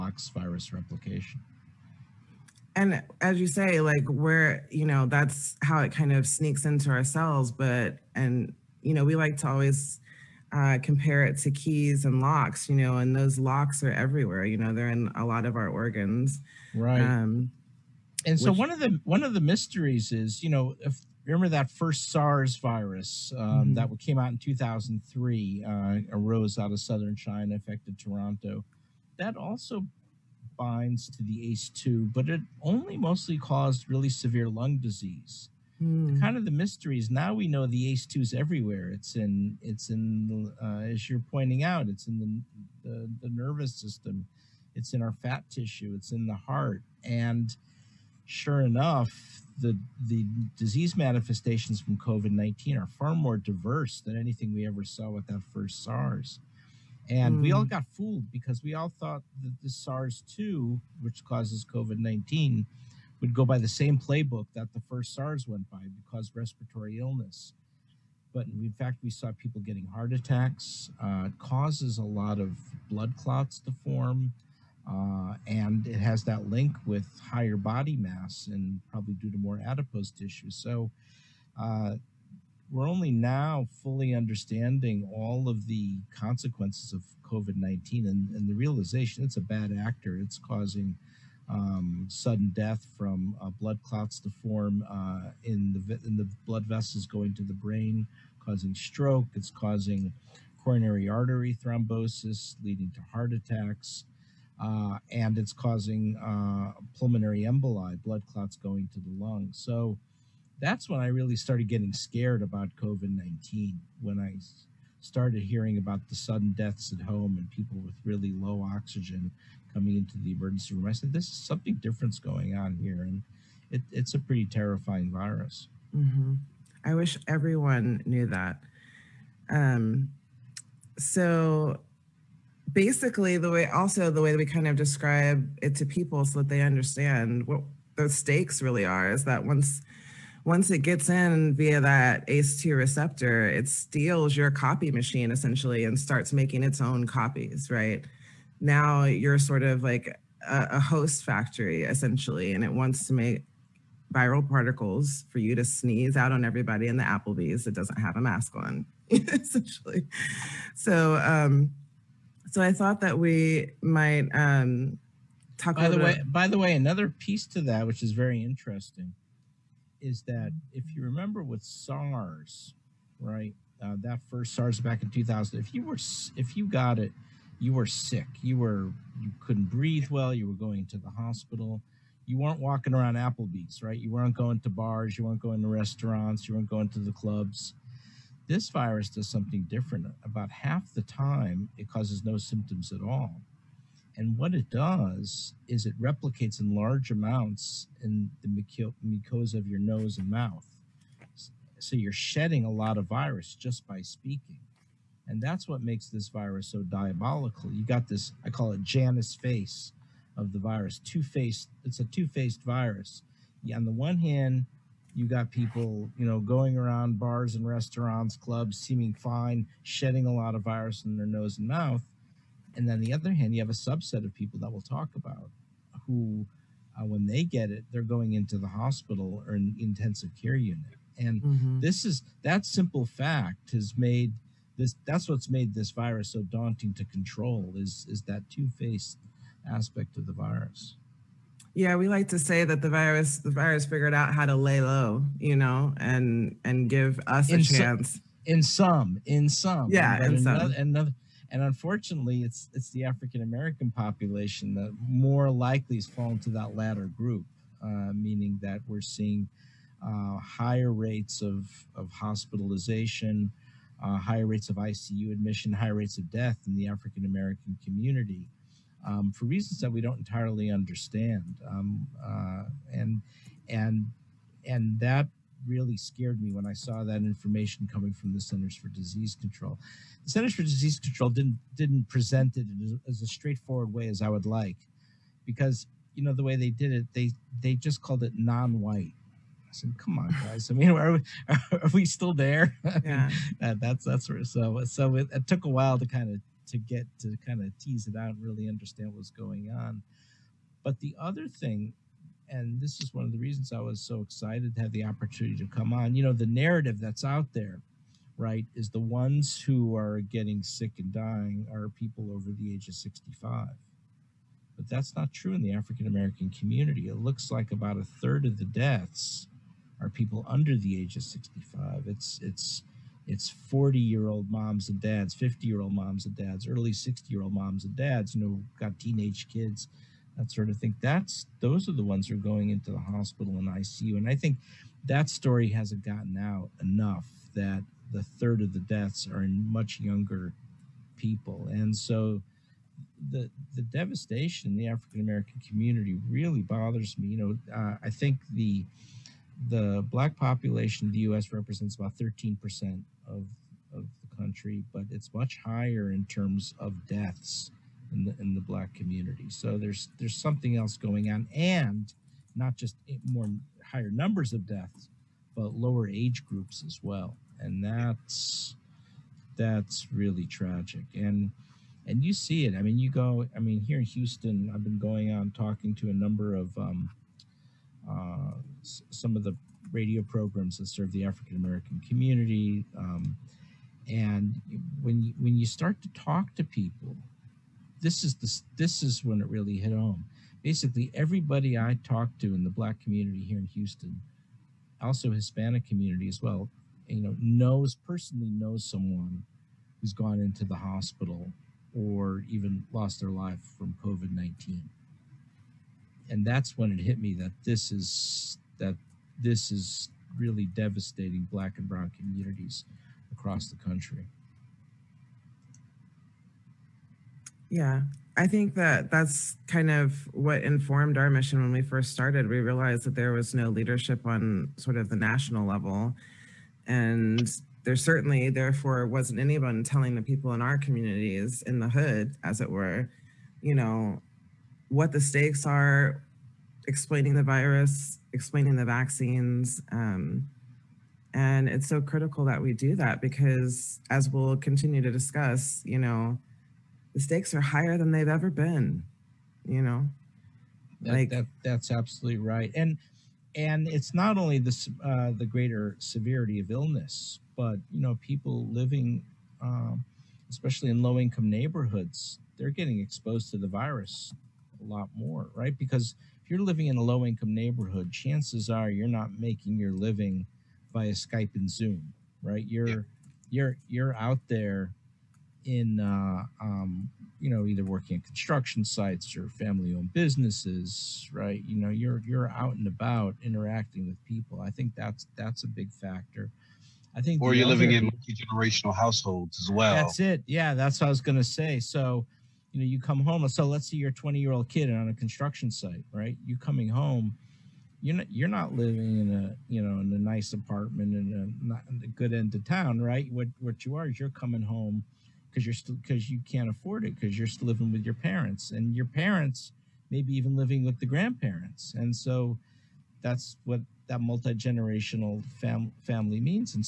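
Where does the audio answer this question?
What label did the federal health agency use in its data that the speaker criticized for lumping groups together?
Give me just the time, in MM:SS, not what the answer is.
04:48.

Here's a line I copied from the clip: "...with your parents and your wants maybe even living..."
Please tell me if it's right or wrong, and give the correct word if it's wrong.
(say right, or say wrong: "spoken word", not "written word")
wrong: "parents", not "wants".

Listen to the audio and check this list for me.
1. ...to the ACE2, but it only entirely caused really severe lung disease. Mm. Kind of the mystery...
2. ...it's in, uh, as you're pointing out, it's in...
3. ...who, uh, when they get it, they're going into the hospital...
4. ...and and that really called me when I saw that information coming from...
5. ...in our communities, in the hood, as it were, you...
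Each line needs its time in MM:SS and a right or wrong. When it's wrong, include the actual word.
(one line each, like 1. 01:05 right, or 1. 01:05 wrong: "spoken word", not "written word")
1. 00:31 wrong: "mostly", not "entirely"
2. 00:39 right
3. 03:46 right
4. 04:33 wrong: "scared", not "called"
5. 07:10 right.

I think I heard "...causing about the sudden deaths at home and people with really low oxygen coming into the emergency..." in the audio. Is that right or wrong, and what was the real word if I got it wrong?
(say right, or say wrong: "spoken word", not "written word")
wrong: "hearing", not "causing".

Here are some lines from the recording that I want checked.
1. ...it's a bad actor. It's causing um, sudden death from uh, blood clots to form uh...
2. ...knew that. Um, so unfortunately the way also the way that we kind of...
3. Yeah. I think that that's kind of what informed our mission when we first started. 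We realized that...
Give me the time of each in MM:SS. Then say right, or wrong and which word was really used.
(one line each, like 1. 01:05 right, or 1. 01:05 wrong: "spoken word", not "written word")
1. 01:29 right
2. 02:08 wrong: "basically", not "unfortunately"
3. 06:57 right.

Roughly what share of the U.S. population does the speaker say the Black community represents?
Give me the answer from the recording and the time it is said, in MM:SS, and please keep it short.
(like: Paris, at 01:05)
13 percent, at 05:52.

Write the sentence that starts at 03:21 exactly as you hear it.
So you're shedding a lot of virus just by speaking.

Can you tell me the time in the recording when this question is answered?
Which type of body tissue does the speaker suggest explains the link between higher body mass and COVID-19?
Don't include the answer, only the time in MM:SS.
01:19.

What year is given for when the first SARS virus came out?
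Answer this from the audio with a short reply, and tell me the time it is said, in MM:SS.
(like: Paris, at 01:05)
2003, at 00:24.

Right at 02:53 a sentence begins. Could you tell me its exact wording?
Uh, that first SARS back in 2000, if you were if you got it, you were sick.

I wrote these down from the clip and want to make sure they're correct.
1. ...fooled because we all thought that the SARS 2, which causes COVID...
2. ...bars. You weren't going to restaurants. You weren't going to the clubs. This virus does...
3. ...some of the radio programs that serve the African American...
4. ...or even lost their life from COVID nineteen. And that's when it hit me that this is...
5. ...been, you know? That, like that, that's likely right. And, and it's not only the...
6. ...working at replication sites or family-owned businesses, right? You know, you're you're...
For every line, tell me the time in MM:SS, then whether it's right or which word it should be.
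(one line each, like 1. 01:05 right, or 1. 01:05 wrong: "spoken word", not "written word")
1. 00:57 right
2. 03:04 right
3. 06:19 right
4. 06:41 right
5. 07:28 wrong: "absolutely", not "likely"
6. 07:57 wrong: "construction", not "replication".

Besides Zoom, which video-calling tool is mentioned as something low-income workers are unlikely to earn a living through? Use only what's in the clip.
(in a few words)
Skype.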